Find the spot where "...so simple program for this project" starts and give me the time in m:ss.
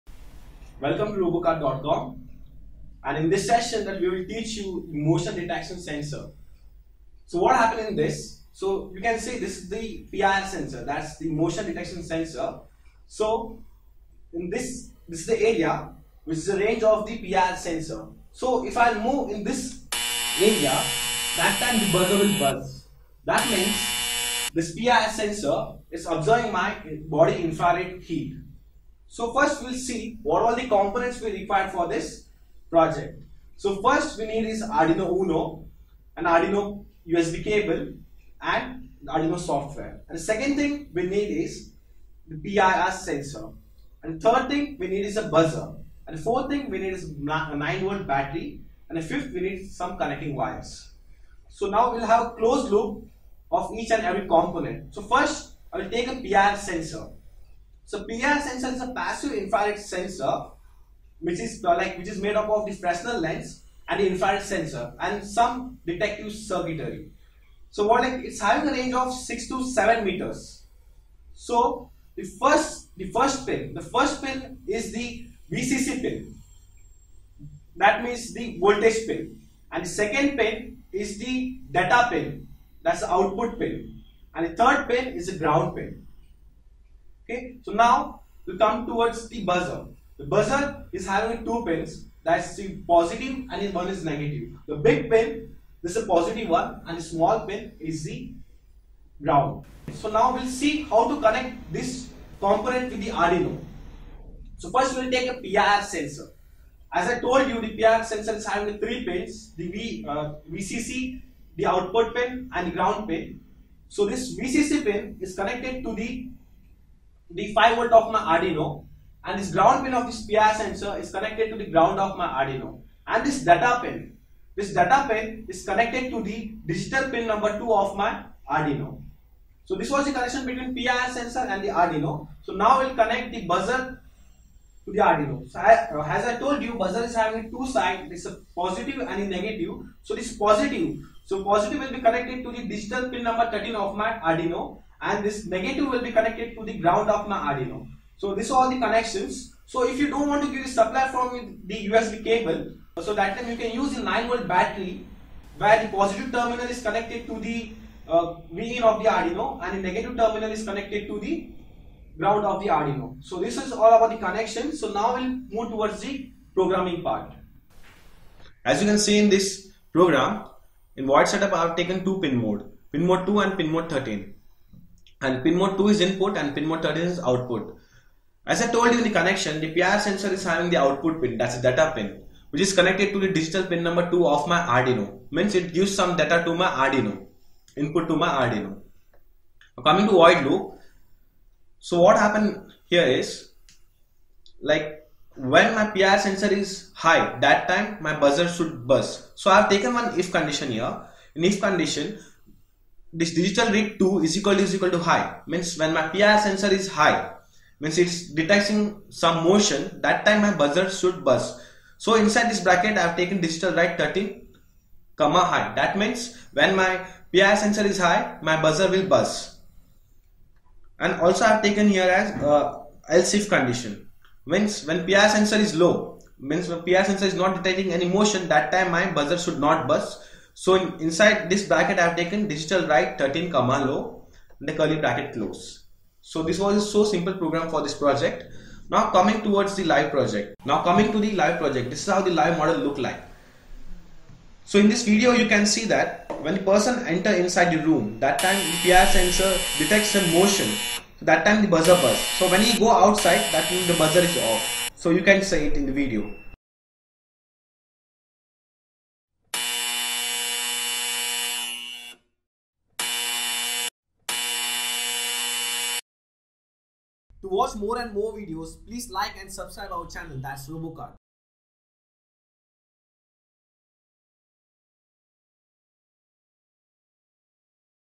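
3:56.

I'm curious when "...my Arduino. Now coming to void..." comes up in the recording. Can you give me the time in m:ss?
3:08.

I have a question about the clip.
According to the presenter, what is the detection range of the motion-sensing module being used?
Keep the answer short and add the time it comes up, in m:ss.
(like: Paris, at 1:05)
6 to 7 meters, at 1:09.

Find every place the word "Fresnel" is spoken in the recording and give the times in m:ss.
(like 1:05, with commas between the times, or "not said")
1:02.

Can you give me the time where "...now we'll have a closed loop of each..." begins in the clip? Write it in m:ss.
0:51.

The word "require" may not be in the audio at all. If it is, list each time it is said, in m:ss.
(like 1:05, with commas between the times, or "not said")
0:31.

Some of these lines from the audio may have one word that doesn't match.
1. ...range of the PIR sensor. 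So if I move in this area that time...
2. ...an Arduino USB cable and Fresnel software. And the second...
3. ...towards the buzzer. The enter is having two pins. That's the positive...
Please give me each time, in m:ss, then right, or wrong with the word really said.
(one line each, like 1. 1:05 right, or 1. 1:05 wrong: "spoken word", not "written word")
1. 0:16 right
2. 0:36 wrong: "Arduino", not "Fresnel"
3. 1:28 wrong: "buzzer", not "enter".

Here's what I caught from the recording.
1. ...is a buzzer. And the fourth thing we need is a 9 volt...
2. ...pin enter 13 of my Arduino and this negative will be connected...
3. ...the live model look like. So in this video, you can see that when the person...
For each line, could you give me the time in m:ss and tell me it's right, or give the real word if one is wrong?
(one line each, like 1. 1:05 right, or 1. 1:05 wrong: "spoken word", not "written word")
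1. 0:45 right
2. 2:23 wrong: "number", not "enter"
3. 4:02 right.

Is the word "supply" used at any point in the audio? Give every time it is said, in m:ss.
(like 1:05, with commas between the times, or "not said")
2:30.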